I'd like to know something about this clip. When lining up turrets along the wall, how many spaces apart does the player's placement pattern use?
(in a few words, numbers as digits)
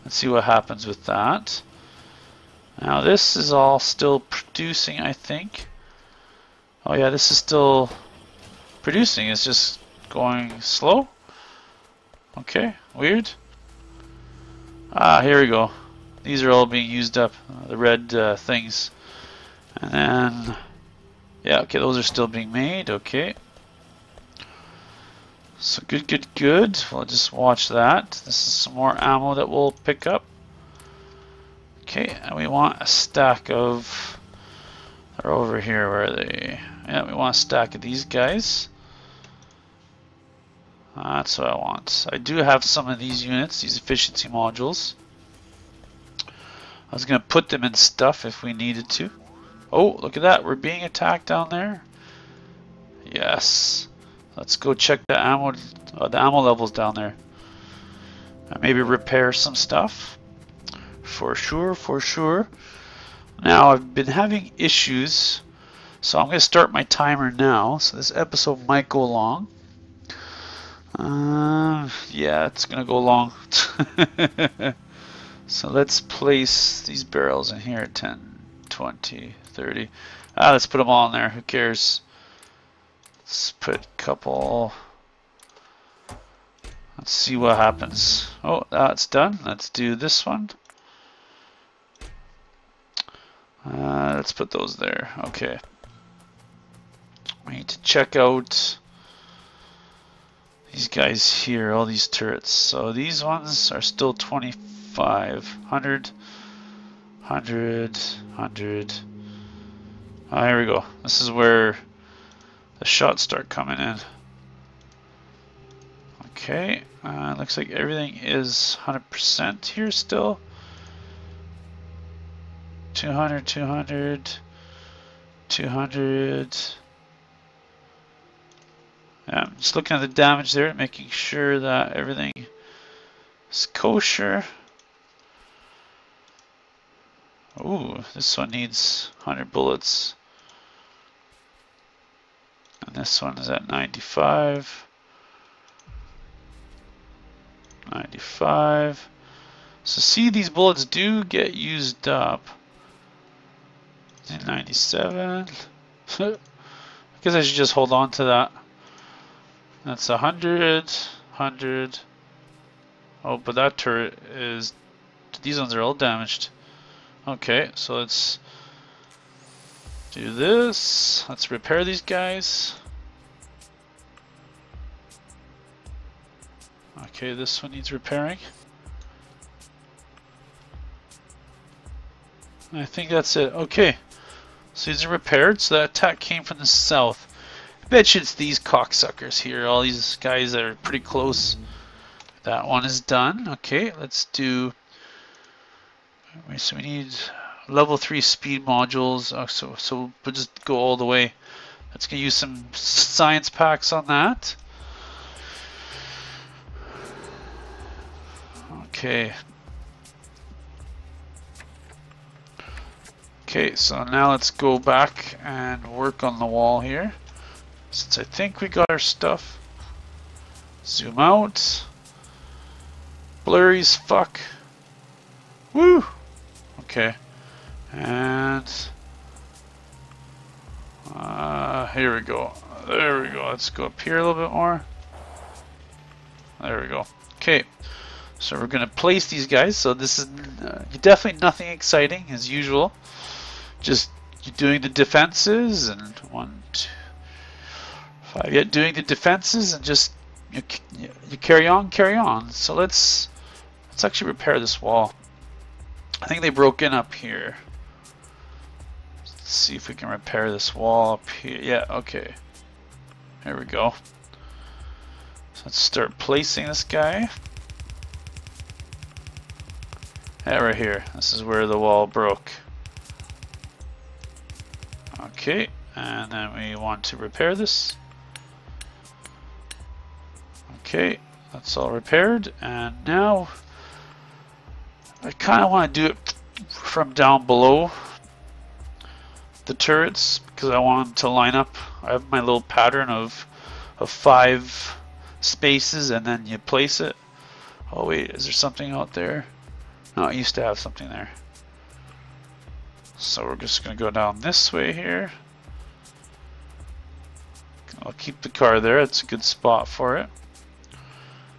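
5.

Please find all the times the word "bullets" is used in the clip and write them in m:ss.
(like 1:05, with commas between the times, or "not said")
2:19, 2:30.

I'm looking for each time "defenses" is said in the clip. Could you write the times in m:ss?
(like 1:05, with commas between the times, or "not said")
4:04, 4:09.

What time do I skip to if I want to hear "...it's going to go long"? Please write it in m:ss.
1:12.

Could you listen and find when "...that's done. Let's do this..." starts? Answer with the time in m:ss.
1:28.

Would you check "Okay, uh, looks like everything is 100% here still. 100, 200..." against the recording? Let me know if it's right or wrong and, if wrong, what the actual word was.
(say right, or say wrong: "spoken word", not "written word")
wrong: "200", not "100".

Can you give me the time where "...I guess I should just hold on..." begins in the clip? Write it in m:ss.
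2:36.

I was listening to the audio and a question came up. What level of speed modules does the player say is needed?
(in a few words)
level 3.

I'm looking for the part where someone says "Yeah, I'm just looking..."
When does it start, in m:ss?
2:09.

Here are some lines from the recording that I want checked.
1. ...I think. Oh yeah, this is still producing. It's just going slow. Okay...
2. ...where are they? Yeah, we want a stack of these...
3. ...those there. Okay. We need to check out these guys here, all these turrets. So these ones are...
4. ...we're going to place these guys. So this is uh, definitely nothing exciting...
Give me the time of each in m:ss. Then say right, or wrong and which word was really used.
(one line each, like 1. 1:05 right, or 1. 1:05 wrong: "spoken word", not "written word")
1. 0:05 right
2. 0:35 right
3. 1:34 right
4. 3:58 right.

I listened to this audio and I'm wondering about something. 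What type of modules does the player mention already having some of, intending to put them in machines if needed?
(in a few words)
efficiency modules.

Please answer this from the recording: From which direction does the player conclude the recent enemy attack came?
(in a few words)
south.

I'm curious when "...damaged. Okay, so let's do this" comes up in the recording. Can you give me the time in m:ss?
2:45.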